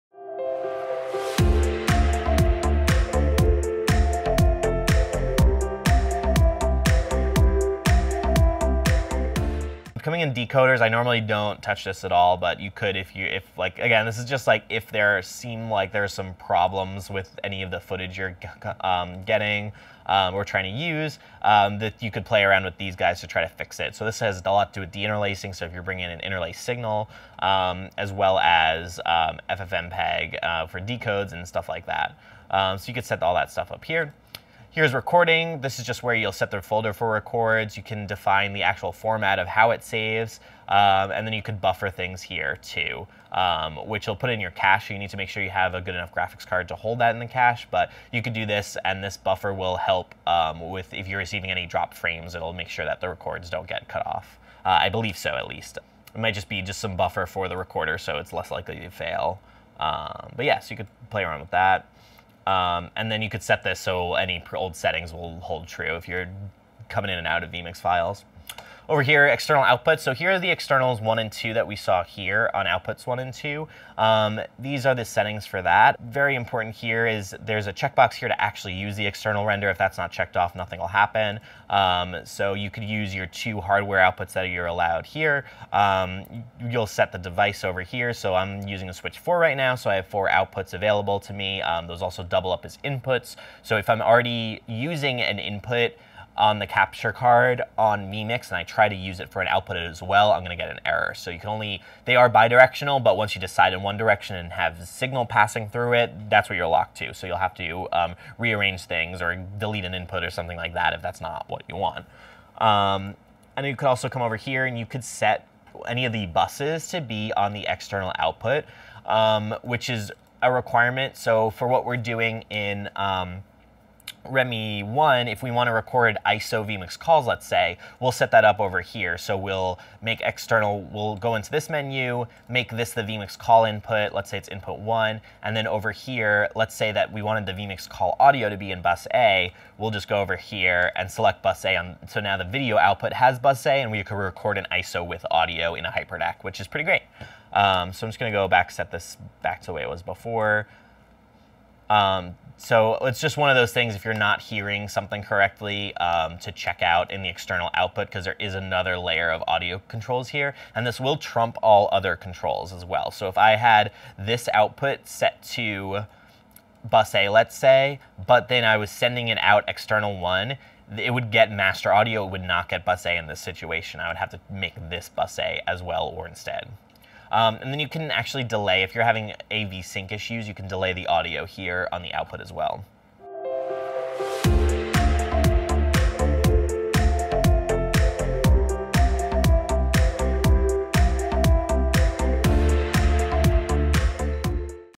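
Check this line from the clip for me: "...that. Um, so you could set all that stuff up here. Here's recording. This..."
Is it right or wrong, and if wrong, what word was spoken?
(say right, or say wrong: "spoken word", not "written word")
right.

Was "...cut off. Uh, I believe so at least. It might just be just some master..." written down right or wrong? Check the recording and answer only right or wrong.
wrong.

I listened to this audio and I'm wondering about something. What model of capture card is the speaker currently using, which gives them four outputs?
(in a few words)
Switch 4.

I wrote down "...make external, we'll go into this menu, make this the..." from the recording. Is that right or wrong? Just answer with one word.
right.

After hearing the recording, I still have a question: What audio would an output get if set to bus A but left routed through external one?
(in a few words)
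master audio.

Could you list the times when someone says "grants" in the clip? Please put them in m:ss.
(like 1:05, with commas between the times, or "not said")
not said.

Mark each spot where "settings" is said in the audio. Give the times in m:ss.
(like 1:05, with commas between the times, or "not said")
1:04, 1:15.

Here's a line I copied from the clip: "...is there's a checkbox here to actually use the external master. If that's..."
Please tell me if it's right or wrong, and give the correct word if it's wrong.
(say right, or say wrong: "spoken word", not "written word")
wrong: "render", not "master".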